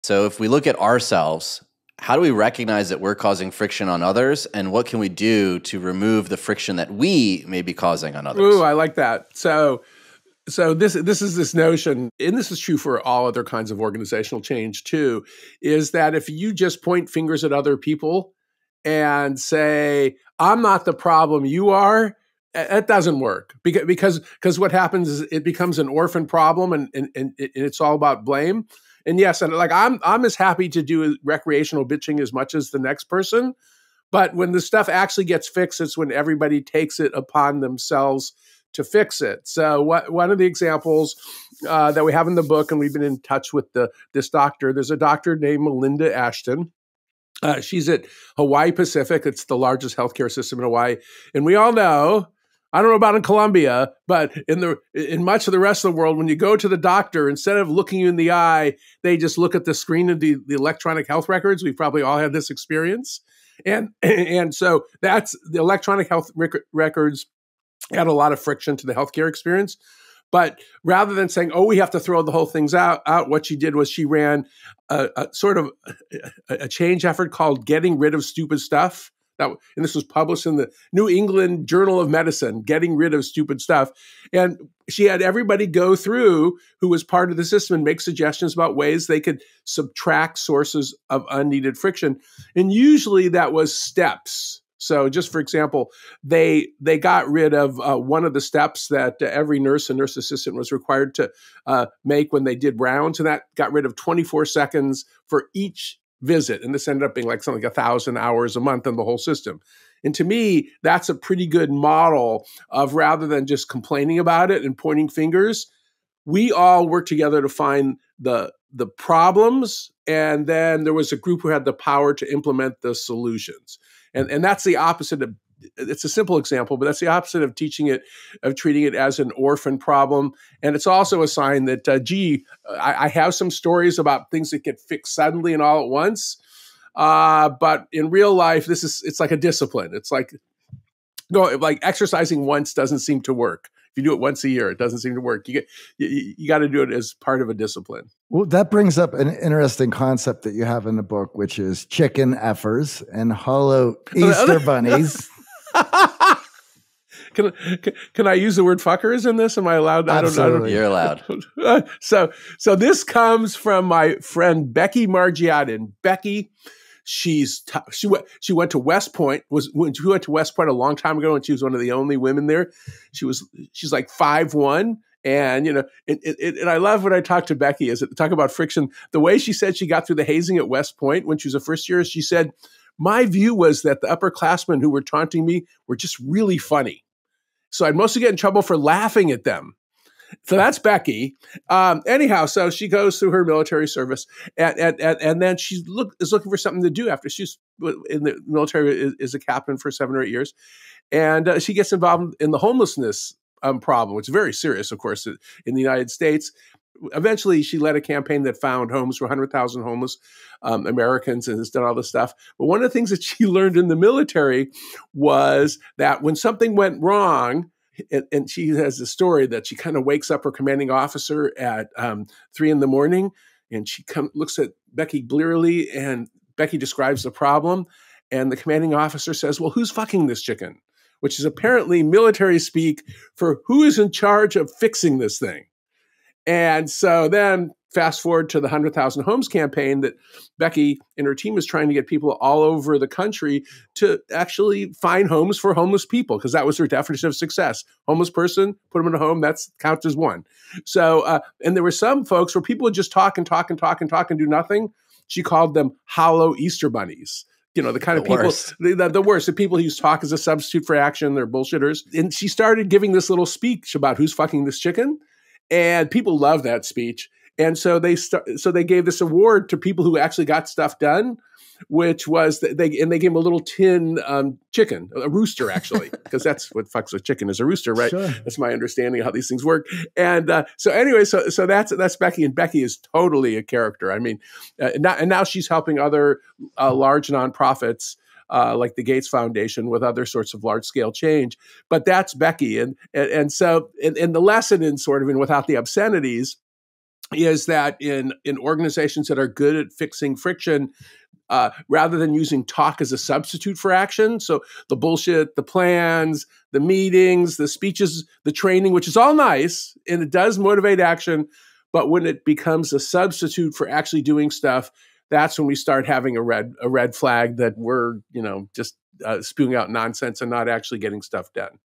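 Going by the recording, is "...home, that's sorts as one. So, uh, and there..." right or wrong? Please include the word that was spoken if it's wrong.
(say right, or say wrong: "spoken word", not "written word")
wrong: "counts", not "sorts".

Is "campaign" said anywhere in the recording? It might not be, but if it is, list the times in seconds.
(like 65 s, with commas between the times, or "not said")
208 s, 239 s.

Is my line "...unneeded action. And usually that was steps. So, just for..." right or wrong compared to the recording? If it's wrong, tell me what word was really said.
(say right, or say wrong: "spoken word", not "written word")
wrong: "friction", not "action".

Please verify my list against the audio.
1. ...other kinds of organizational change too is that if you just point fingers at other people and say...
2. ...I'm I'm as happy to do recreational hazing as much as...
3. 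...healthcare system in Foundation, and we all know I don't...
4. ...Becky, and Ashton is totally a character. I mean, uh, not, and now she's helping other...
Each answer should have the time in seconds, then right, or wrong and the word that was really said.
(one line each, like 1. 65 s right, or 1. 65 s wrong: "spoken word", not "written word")
1. 13 s right
2. 29 s wrong: "bitching", not "hazing"
3. 49 s wrong: "Hawaii", not "Foundation"
4. 282 s wrong: "Becky", not "Ashton".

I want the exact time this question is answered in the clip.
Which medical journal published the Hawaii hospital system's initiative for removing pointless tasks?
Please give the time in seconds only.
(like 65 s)
80 s.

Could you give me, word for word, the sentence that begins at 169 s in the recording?
Was when she went to West Point a long time ago, and she was one of the only women there.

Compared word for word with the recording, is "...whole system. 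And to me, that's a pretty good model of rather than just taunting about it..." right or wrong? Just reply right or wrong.
wrong.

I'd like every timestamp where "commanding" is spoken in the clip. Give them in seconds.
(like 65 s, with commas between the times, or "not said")
220 s, 228 s.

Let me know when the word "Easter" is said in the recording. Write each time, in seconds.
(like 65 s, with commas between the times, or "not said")
154 s, 256 s.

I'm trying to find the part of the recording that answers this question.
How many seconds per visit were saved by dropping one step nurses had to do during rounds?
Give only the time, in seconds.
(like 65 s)
103 s.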